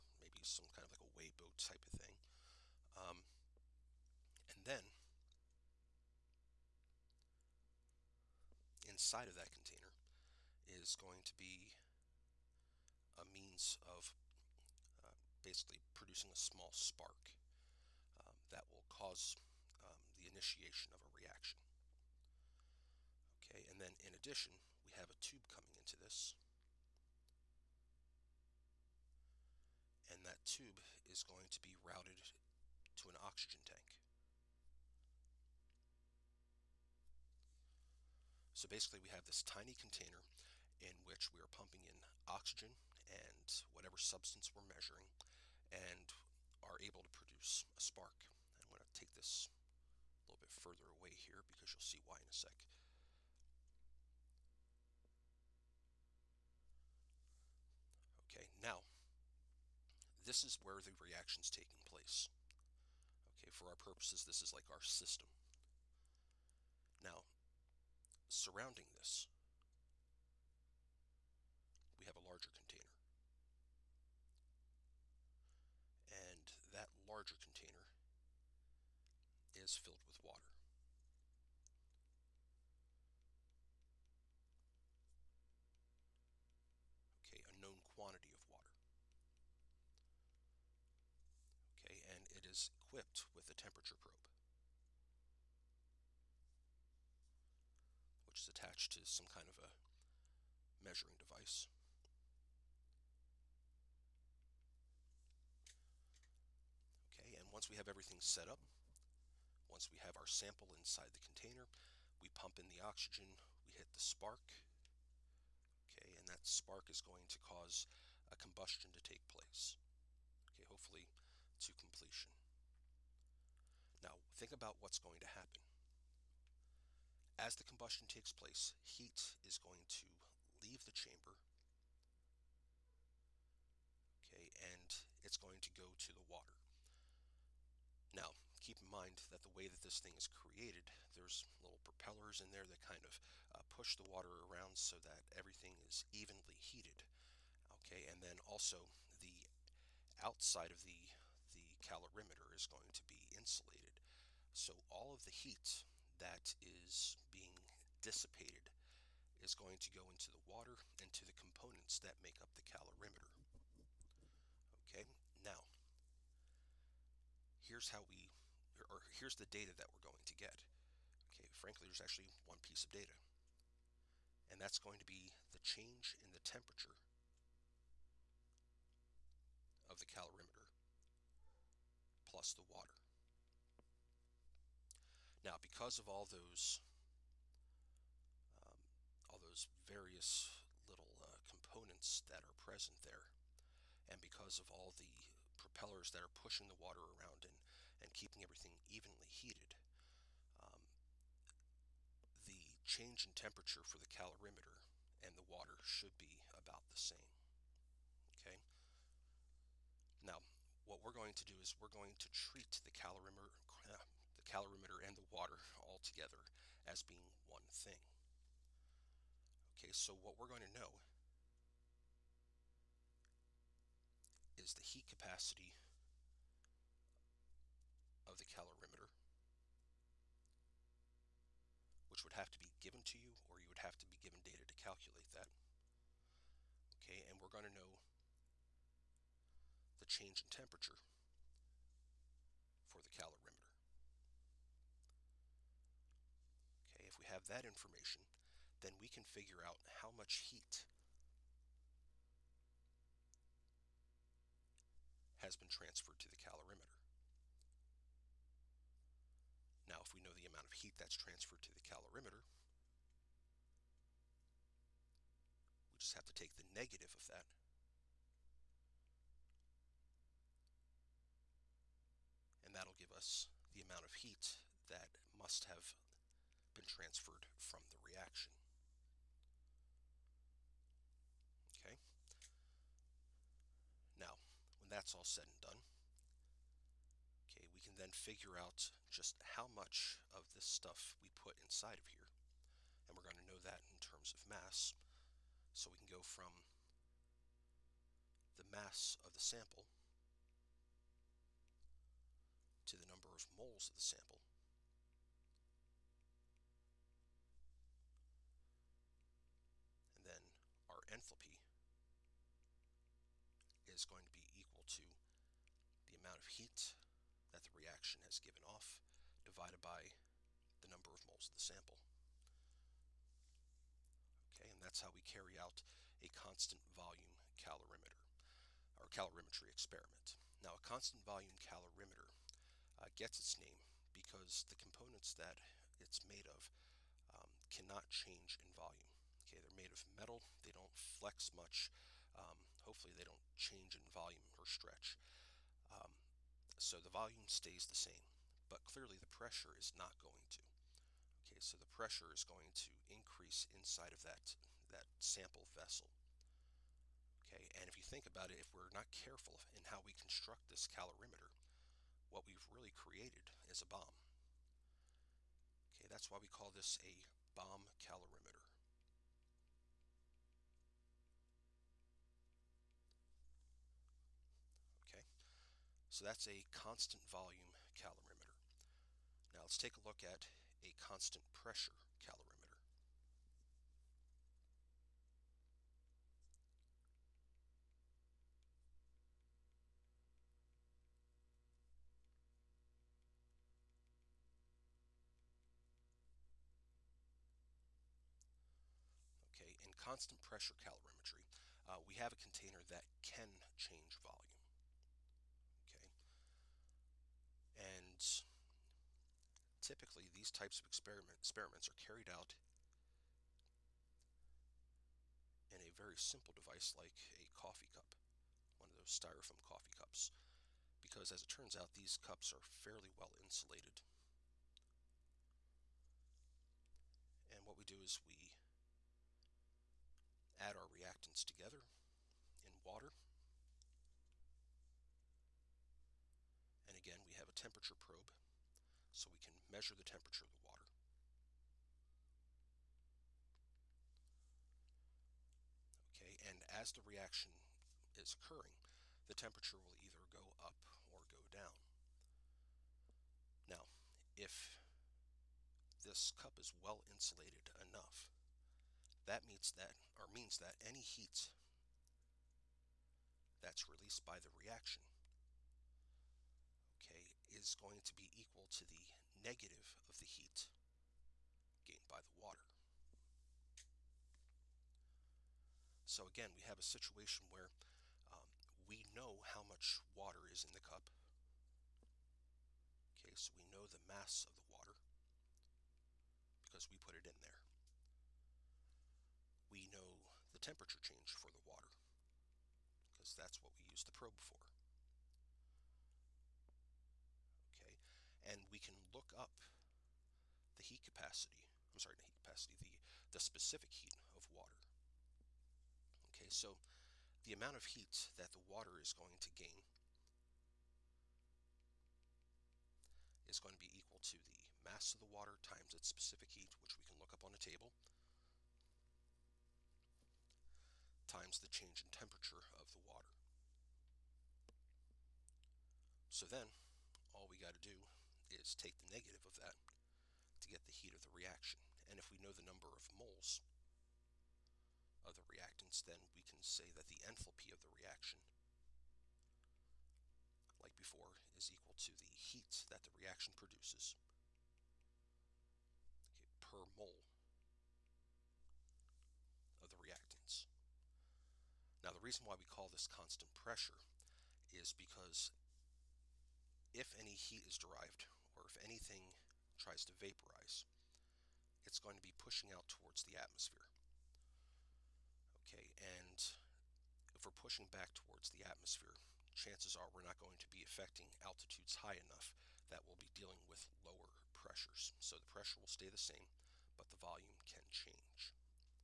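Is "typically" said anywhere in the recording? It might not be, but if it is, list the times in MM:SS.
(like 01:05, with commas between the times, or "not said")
06:49.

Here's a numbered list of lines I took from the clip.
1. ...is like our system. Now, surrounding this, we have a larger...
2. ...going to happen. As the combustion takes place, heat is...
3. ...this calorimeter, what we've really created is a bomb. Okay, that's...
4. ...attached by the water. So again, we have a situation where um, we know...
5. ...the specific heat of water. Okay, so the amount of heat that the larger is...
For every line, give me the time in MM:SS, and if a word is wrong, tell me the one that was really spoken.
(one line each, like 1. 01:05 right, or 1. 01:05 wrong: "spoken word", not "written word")
1. 01:04 right
2. 02:04 right
3. 06:00 right
4. 07:51 wrong: "gained", not "attached"
5. 08:23 wrong: "water", not "larger".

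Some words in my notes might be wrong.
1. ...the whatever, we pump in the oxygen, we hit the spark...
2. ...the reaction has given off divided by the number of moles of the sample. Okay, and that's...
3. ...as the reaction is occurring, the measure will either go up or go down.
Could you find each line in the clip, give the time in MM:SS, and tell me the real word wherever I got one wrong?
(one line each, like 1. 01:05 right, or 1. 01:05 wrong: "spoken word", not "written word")
1. 01:51 wrong: "container", not "whatever"
2. 05:17 right
3. 07:26 wrong: "temperature", not "measure".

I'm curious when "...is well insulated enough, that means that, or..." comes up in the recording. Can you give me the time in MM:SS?
07:36.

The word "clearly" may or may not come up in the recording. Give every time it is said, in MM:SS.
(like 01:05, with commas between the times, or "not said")
05:48.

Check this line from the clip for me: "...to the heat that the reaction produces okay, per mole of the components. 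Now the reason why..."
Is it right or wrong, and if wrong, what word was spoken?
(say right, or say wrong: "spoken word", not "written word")
wrong: "reactants", not "components".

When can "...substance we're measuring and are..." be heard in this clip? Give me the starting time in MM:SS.
00:43.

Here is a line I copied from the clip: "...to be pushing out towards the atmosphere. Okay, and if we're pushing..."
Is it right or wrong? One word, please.
right.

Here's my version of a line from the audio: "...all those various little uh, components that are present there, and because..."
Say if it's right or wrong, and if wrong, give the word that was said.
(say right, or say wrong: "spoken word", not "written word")
right.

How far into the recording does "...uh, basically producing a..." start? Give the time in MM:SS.
00:15.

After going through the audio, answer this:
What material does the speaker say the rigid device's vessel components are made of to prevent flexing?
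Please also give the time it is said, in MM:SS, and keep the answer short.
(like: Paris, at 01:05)
Metal, at 05:40.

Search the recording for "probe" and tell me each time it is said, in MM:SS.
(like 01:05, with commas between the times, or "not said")
01:33, 07:17, 08:14.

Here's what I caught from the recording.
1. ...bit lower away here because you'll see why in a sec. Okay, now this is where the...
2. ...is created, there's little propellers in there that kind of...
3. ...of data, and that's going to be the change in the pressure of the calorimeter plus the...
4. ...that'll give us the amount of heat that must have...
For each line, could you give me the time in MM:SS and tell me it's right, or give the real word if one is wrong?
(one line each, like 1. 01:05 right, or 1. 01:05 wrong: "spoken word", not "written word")
1. 00:50 wrong: "further", not "lower"
2. 02:20 right
3. 02:52 wrong: "temperature", not "pressure"
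4. 04:32 right.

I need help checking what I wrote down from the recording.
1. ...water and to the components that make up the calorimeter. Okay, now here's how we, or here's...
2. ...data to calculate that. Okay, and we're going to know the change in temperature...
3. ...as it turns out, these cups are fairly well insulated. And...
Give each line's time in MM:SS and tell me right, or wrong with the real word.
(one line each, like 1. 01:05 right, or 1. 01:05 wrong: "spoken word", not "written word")
1. 02:40 right
2. 03:54 right
3. 07:01 right.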